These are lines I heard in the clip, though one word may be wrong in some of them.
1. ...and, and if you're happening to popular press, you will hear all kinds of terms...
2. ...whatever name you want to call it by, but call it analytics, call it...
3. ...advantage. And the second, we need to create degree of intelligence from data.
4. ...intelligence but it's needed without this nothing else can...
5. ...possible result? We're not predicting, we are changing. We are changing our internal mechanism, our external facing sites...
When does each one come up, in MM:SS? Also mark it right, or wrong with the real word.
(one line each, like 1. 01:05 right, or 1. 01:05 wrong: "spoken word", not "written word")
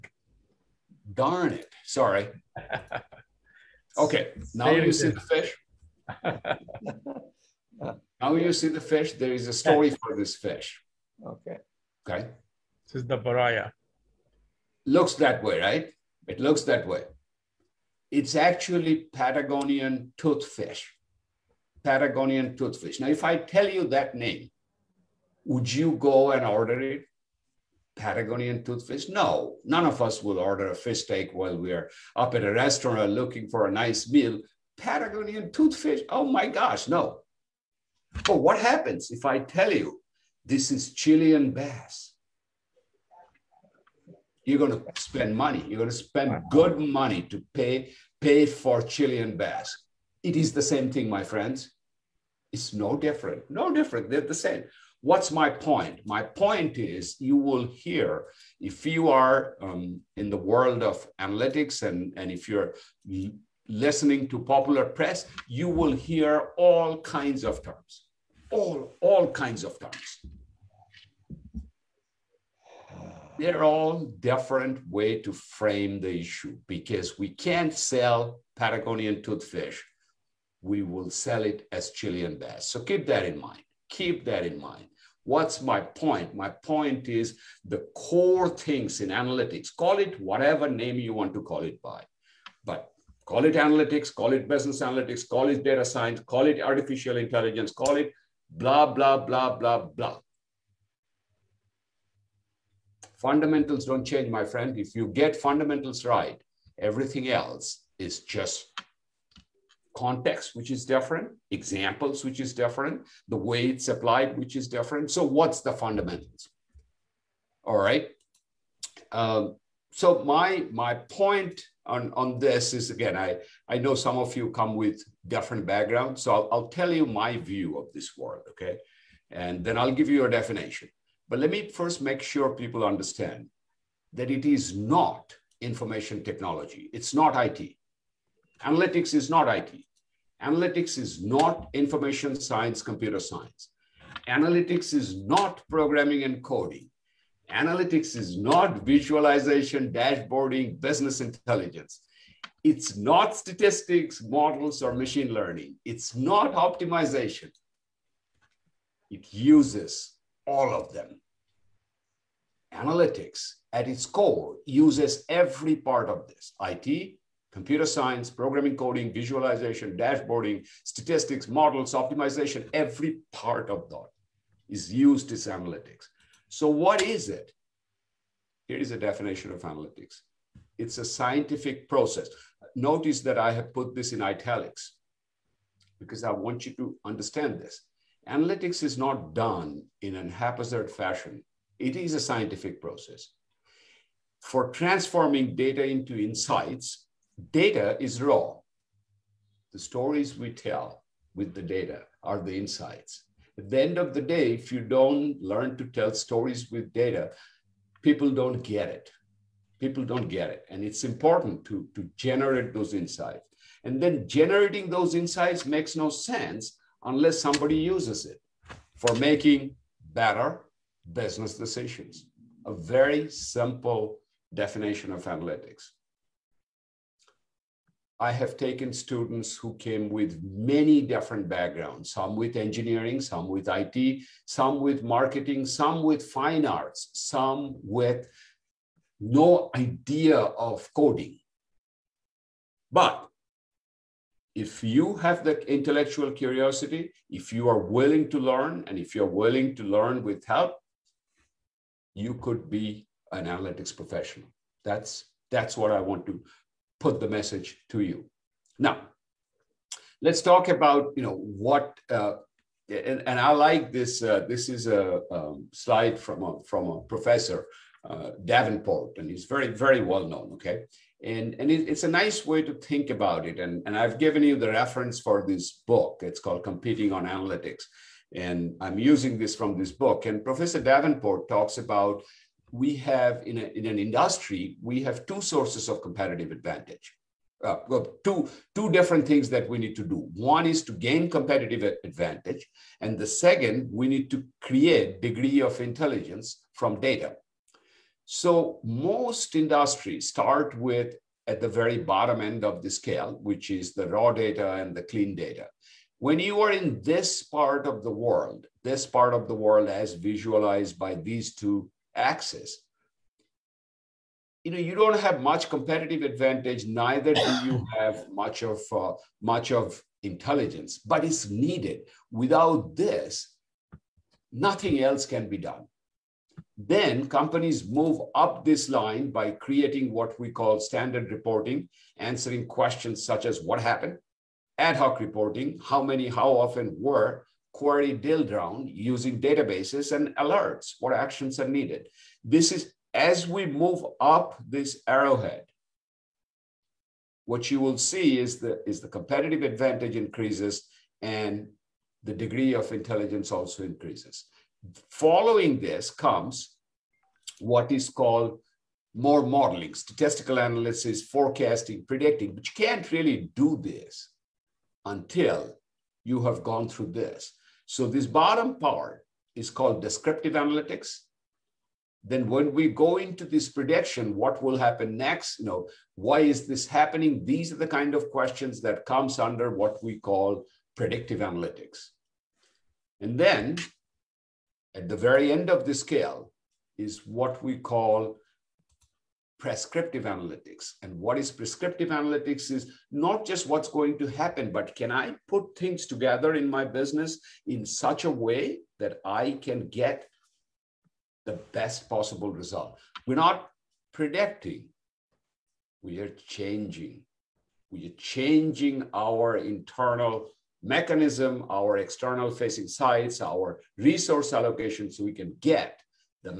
1. 01:01 wrong: "listening", not "happening"
2. 01:30 right
3. 04:52 right
4. 05:20 right
5. 06:42 right.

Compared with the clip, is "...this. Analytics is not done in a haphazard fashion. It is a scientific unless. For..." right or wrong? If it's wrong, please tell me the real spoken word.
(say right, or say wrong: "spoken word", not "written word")
wrong: "process", not "unless".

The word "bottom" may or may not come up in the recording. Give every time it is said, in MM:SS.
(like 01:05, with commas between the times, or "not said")
05:01, 06:08.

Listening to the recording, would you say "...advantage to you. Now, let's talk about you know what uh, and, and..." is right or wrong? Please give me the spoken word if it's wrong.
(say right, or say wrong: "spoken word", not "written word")
wrong: "message", not "advantage".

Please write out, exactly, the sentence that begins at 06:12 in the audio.
Then when we go into this prediction, what will happen next?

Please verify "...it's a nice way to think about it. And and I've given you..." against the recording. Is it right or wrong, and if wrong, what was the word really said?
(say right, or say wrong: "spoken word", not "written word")
right.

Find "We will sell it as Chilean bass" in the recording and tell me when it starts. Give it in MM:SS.
01:20.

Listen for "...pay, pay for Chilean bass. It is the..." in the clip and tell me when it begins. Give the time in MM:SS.
00:47.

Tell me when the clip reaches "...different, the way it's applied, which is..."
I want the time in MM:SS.
01:52.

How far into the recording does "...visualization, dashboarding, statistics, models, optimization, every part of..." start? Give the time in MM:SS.
02:49.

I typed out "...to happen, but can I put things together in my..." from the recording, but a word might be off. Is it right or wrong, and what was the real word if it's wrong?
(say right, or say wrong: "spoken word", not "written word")
right.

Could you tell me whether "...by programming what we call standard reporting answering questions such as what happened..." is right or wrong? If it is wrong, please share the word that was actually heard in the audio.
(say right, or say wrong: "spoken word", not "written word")
wrong: "creating", not "programming".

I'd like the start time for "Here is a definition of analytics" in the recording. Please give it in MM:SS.
02:58.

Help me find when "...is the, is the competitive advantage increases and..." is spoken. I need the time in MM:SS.
05:48.